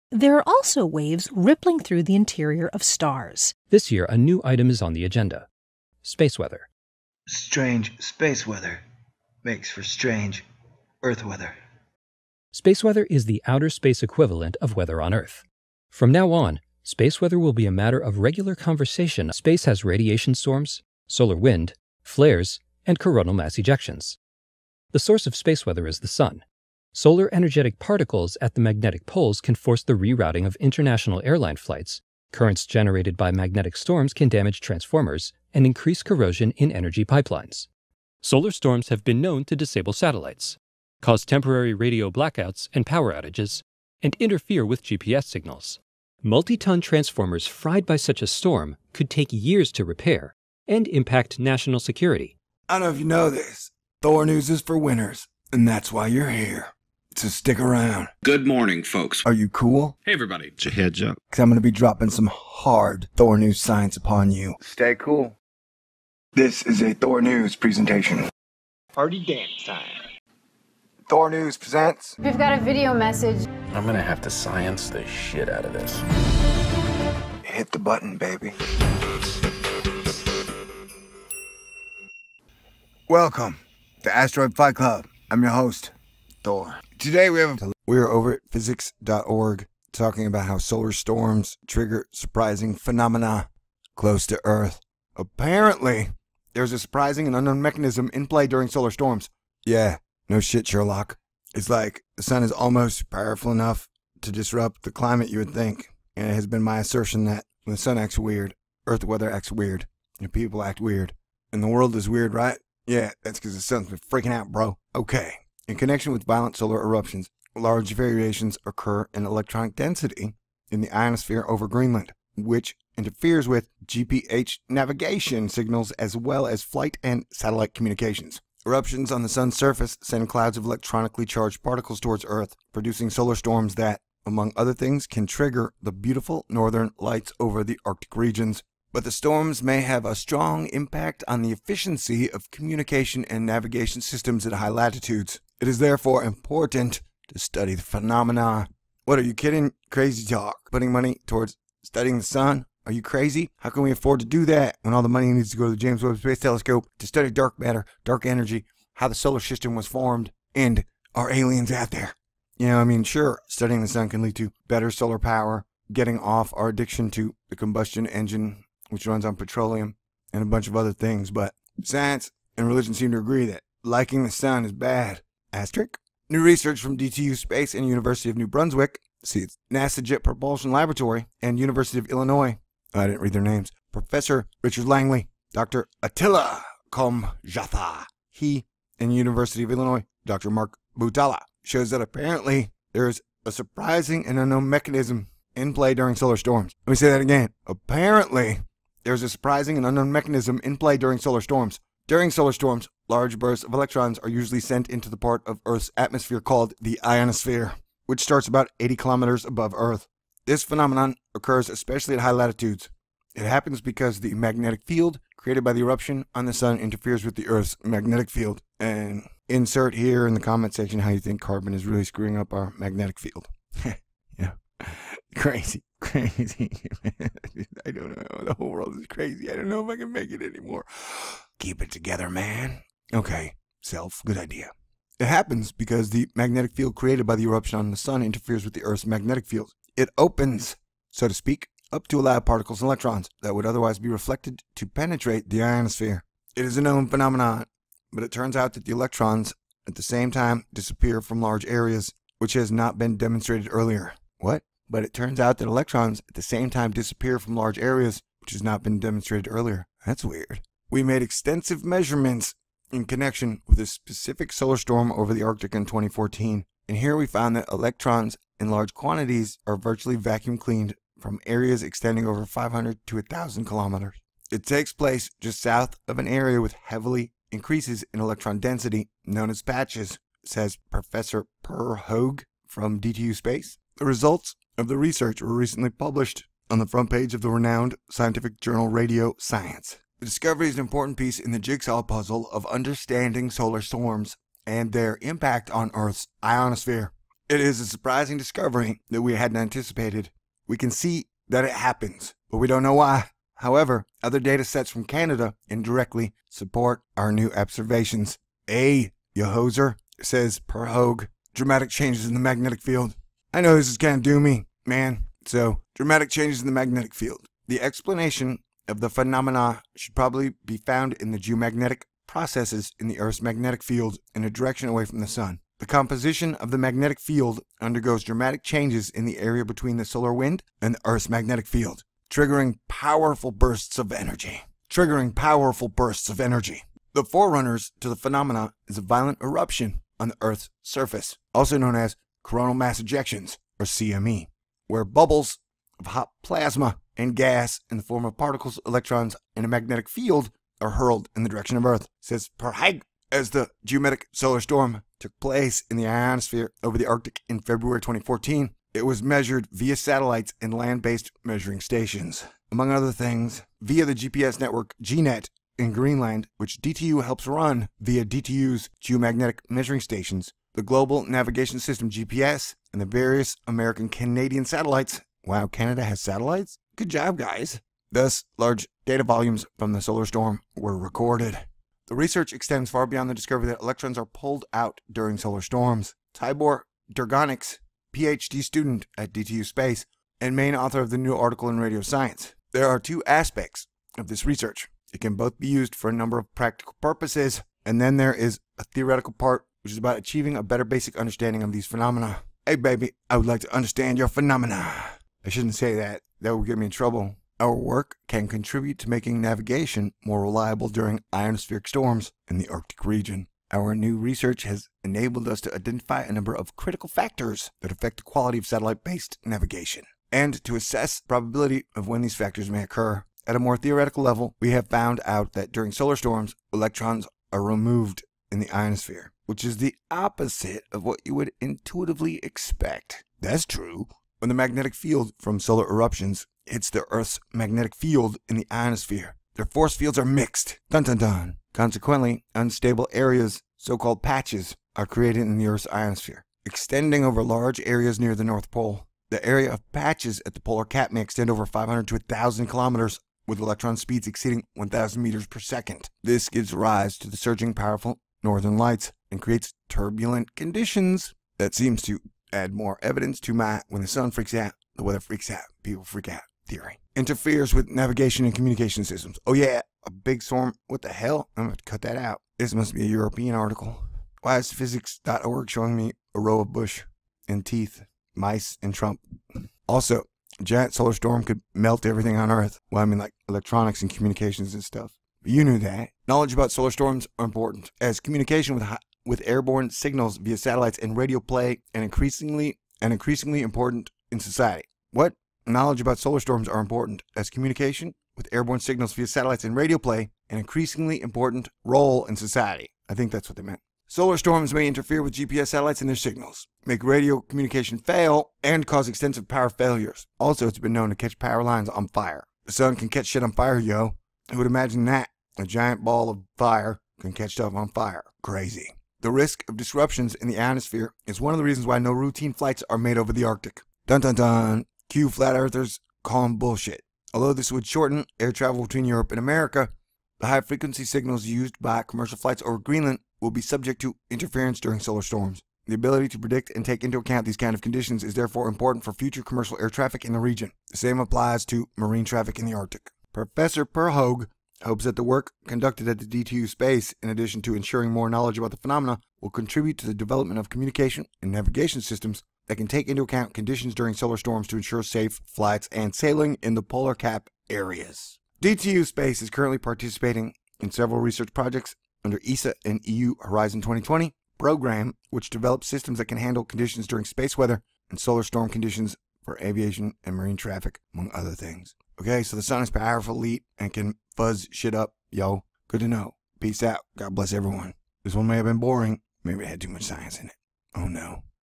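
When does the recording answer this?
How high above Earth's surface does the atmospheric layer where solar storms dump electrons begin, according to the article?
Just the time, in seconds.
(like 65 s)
208 s.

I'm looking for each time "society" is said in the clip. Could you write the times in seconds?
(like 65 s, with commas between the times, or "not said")
494 s, 502 s.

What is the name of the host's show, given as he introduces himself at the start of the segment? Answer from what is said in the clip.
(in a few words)
Asteroid Fight Club.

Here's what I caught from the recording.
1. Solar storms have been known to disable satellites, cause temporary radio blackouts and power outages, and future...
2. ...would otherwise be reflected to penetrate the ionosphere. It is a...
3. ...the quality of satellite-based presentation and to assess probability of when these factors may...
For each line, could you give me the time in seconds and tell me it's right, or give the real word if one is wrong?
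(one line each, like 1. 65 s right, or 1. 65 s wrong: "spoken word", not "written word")
1. 38 s wrong: "interfere", not "future"
2. 243 s right
3. 418 s wrong: "navigation", not "presentation".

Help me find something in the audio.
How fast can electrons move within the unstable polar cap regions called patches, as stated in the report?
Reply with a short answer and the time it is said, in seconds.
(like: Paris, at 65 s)
over 1,000 meters per second, at 454 s.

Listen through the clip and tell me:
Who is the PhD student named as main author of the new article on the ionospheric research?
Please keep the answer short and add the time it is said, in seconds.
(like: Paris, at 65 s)
Tibor Durgonics, at 386 s.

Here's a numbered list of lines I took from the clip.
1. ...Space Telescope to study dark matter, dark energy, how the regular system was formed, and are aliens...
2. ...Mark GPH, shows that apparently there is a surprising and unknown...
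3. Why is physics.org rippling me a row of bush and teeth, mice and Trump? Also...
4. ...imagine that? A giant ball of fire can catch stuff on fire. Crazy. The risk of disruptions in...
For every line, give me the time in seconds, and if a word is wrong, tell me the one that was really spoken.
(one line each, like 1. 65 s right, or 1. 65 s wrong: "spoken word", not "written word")
1. 156 s wrong: "solar", not "regular"
2. 190 s wrong: "Butala", not "GPH"
3. 474 s wrong: "showing", not "rippling"
4. 514 s right.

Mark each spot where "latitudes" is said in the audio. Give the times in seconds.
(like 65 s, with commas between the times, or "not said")
144 s, 212 s.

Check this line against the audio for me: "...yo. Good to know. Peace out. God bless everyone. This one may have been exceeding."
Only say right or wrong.
wrong.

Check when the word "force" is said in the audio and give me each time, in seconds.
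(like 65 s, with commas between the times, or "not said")
29 s, 439 s.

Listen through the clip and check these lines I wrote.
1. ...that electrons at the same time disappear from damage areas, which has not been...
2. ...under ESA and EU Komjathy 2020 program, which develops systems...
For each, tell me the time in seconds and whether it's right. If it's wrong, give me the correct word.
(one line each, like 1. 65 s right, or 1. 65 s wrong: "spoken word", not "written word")
1. 255 s wrong: "large", not "damage"
2. 562 s wrong: "Horizon", not "Komjathy".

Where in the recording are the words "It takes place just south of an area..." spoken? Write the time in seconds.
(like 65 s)
274 s.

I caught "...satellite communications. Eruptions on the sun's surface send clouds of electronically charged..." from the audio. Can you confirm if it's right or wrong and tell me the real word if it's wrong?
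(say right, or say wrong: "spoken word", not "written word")
right.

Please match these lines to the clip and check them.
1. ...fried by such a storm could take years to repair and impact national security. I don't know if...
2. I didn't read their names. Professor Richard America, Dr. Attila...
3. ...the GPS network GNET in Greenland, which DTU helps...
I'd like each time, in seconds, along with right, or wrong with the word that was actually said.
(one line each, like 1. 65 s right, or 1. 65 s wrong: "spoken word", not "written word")
1. 47 s right
2. 182 s wrong: "Langley", not "America"
3. 364 s right.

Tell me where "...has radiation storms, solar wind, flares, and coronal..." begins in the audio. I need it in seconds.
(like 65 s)
19 s.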